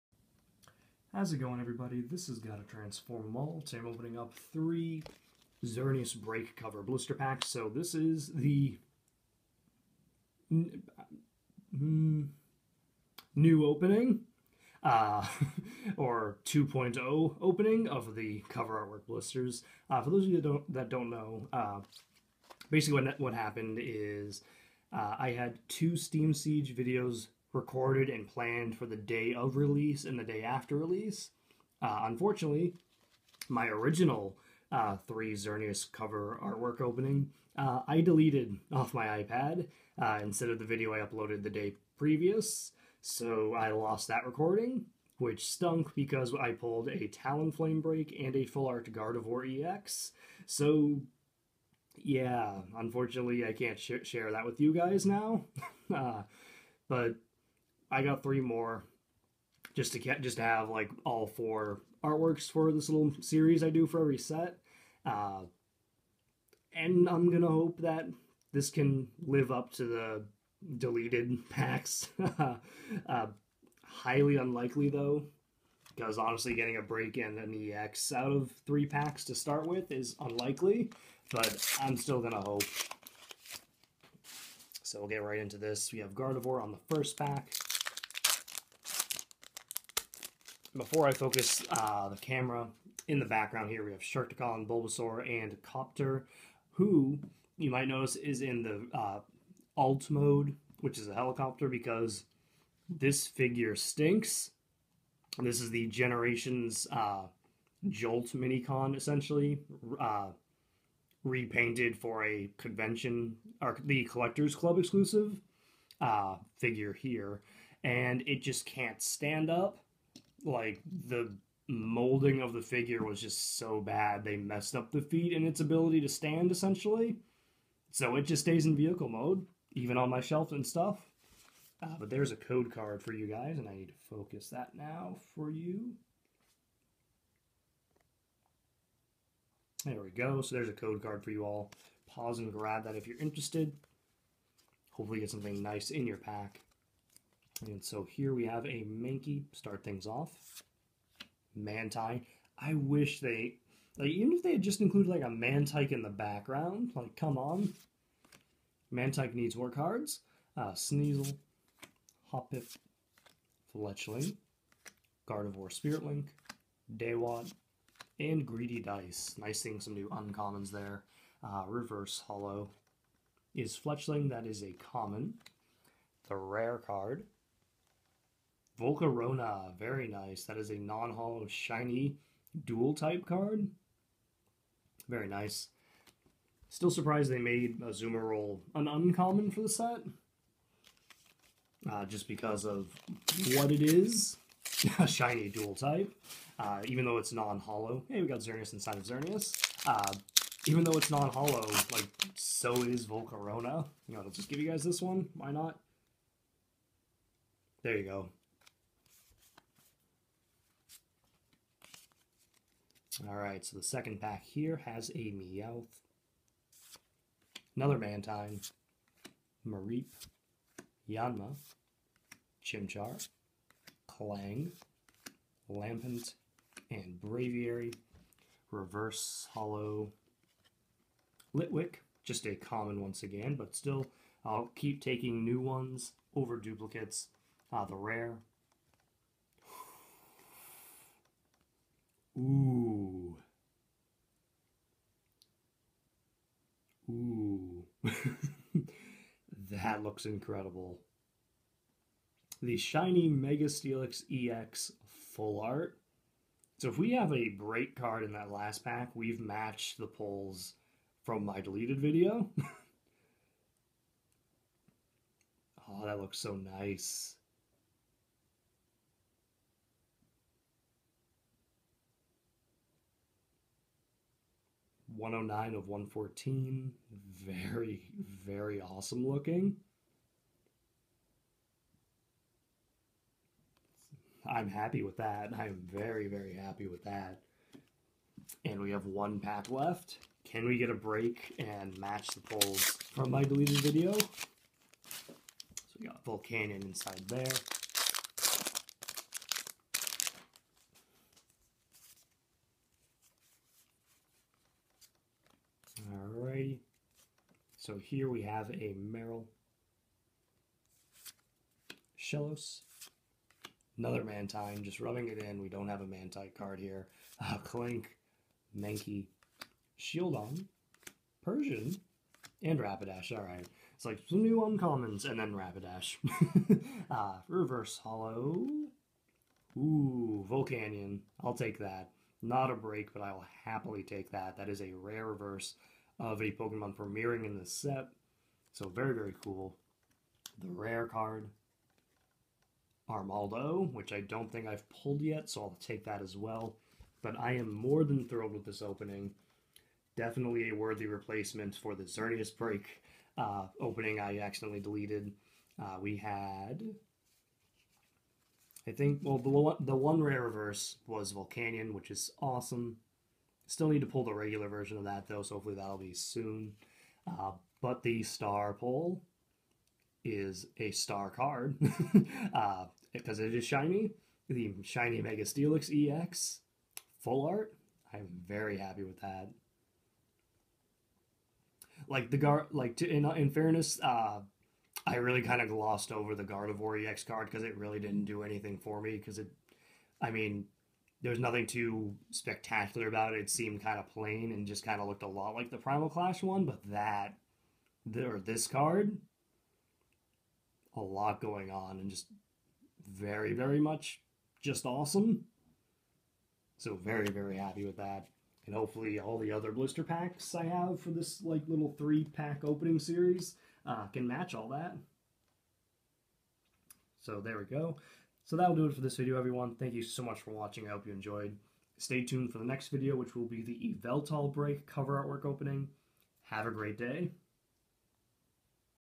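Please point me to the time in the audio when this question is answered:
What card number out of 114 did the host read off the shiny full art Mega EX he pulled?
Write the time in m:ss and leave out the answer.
4:35.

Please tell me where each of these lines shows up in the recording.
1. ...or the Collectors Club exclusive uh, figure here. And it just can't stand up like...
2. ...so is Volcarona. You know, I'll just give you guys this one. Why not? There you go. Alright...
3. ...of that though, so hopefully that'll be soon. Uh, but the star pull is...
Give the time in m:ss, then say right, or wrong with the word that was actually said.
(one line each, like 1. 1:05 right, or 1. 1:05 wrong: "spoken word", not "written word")
1. 1:53 right
2. 3:22 right
3. 6:04 right.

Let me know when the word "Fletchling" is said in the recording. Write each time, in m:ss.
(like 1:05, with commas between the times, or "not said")
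2:43, 2:53.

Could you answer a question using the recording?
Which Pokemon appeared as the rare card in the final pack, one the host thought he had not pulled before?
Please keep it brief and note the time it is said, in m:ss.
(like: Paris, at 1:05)
Armaldo, at 5:43.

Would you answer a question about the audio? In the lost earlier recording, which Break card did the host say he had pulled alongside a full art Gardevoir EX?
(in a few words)
Talonflame.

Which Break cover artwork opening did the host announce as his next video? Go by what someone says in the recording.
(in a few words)
Yveltal Break.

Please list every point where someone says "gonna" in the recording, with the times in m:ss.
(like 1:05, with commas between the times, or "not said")
1:07, 1:22.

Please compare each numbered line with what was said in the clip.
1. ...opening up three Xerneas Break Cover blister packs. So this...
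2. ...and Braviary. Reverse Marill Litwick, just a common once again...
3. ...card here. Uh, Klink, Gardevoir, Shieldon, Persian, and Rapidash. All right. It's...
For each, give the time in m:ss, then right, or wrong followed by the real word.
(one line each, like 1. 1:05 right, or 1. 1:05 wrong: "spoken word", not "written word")
1. 0:03 right
2. 3:46 wrong: "Holo", not "Marill"
3. 5:16 wrong: "Mankey", not "Gardevoir".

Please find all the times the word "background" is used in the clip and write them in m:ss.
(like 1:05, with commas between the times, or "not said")
1:33, 2:36.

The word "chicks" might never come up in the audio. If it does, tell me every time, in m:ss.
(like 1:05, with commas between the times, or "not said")
not said.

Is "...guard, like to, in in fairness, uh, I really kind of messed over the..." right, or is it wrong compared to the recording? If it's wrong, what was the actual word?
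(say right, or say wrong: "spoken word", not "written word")
wrong: "glossed", not "messed".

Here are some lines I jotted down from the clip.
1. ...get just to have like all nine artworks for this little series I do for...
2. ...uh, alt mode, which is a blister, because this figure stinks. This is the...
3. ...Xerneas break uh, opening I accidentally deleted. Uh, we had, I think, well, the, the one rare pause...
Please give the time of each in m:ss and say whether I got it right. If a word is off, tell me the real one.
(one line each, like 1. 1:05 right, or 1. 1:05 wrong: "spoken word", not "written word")
1. 0:59 wrong: "four", not "nine"
2. 1:38 wrong: "helicopter", not "blister"
3. 5:52 wrong: "reverse", not "pause".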